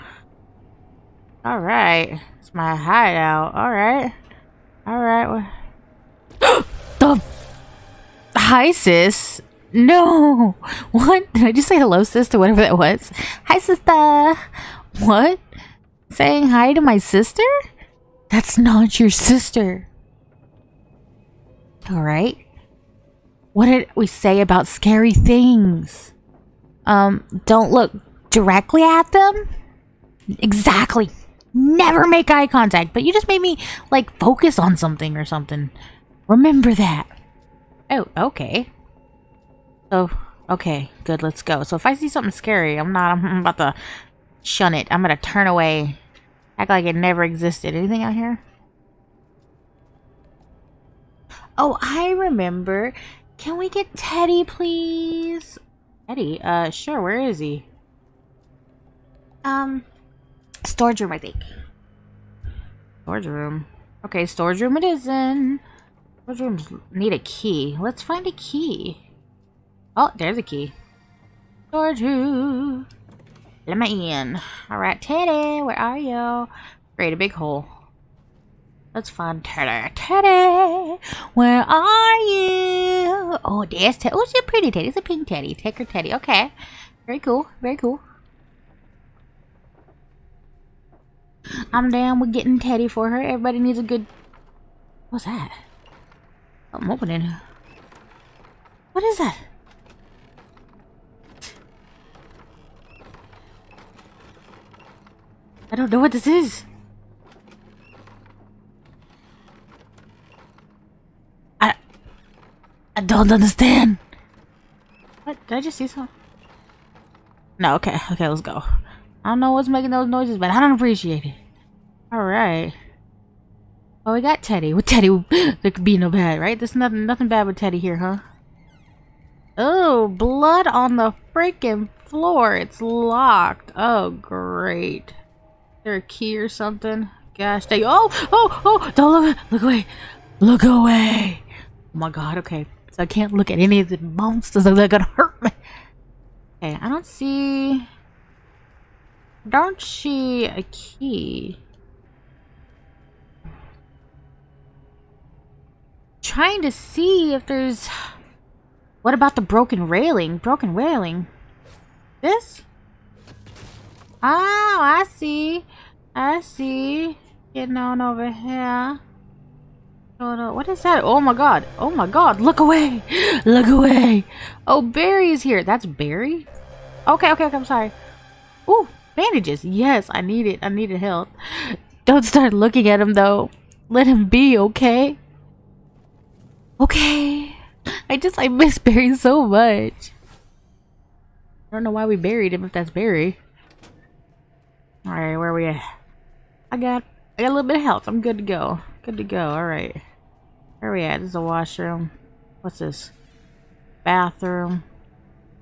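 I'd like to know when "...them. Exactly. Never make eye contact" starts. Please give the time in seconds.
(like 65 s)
29 s.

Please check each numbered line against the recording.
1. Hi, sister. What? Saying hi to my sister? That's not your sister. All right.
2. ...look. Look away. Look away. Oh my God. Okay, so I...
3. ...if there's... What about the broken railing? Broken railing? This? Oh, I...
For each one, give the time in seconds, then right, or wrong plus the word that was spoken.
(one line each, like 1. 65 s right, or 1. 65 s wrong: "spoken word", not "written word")
1. 13 s right
2. 139 s right
3. 157 s right.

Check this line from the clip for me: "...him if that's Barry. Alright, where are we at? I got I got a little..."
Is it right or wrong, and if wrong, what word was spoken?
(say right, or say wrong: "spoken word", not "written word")
right.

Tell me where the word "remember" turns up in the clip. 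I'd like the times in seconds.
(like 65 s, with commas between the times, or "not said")
36 s, 52 s.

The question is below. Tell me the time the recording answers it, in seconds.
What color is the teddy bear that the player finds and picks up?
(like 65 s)
85 s.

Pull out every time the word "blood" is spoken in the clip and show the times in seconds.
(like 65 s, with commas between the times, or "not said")
130 s.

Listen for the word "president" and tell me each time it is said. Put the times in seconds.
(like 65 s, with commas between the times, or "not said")
not said.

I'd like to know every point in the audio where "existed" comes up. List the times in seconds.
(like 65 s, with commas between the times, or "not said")
47 s.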